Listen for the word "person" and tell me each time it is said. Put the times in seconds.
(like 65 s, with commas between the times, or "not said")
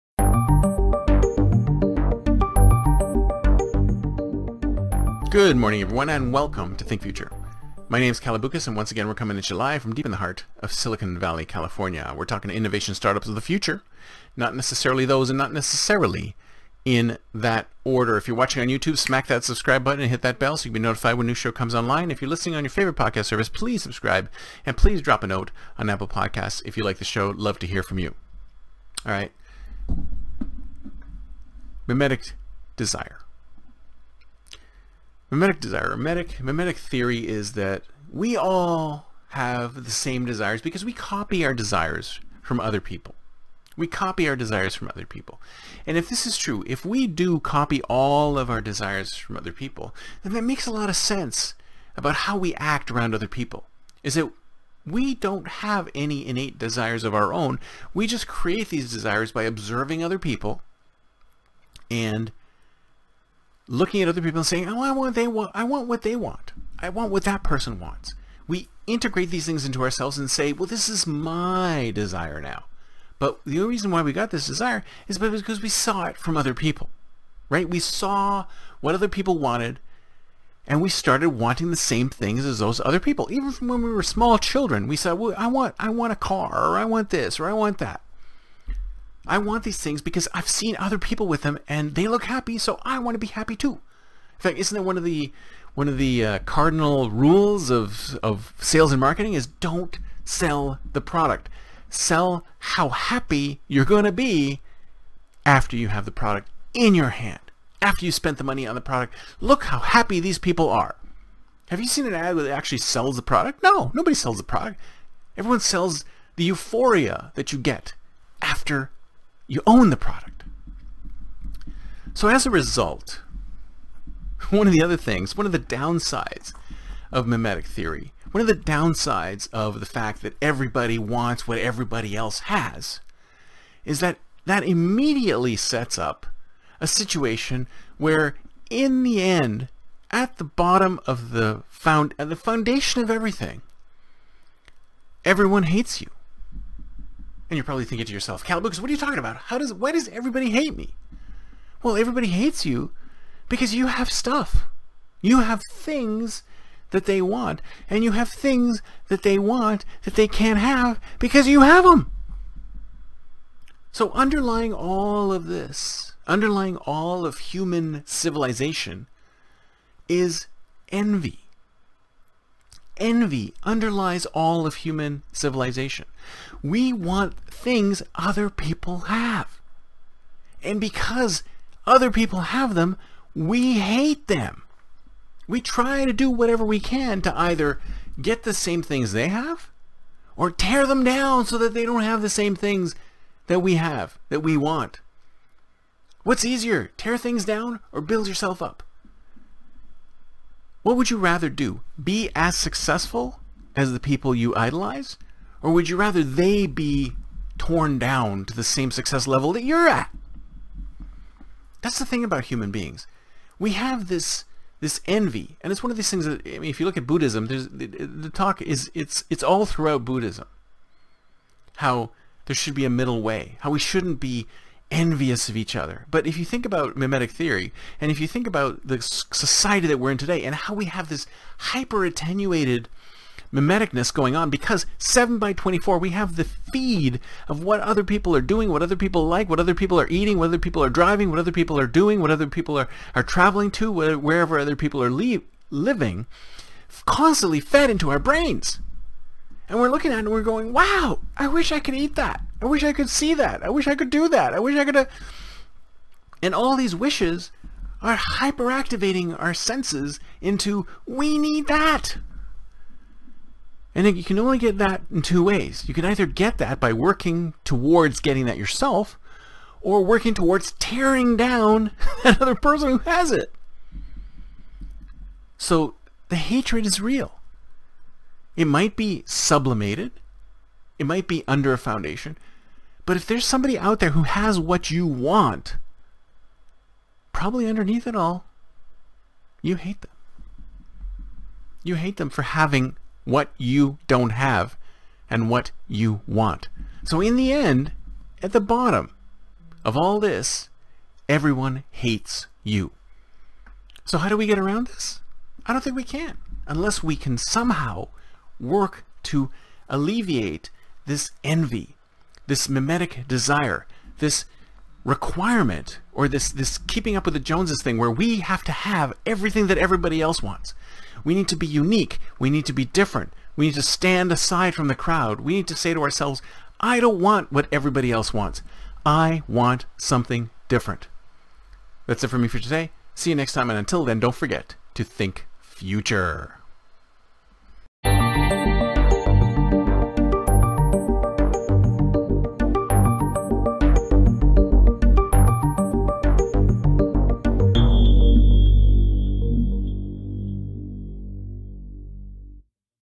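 67 s, 272 s.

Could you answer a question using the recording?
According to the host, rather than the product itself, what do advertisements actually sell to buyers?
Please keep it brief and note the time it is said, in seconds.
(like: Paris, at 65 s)
The euphoria, at 116 s.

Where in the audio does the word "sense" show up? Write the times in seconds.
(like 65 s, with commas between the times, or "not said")
50 s, 259 s.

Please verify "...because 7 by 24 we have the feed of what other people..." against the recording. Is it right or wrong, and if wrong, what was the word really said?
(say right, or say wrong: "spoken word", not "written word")
right.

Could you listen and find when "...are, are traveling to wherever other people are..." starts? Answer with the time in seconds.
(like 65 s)
242 s.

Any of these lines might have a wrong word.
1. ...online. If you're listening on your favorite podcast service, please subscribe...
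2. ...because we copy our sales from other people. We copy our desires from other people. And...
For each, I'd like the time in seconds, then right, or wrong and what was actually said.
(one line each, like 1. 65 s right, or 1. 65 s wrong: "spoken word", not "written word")
1. 21 s right
2. 40 s wrong: "desires", not "sales".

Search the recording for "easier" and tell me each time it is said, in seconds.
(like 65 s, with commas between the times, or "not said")
196 s.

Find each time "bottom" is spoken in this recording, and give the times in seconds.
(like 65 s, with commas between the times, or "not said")
140 s, 298 s.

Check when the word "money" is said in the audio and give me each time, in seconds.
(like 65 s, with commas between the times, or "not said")
108 s.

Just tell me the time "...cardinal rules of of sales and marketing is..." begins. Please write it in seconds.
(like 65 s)
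96 s.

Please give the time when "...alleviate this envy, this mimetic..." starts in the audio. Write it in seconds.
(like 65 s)
309 s.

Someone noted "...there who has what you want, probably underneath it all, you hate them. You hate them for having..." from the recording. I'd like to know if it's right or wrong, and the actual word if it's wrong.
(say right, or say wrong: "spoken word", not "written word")
right.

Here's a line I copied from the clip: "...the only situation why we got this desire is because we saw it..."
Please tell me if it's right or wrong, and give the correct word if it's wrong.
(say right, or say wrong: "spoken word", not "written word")
wrong: "reason", not "situation".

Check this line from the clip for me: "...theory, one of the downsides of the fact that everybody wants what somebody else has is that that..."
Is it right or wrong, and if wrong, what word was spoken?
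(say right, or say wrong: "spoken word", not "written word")
wrong: "everybody", not "somebody".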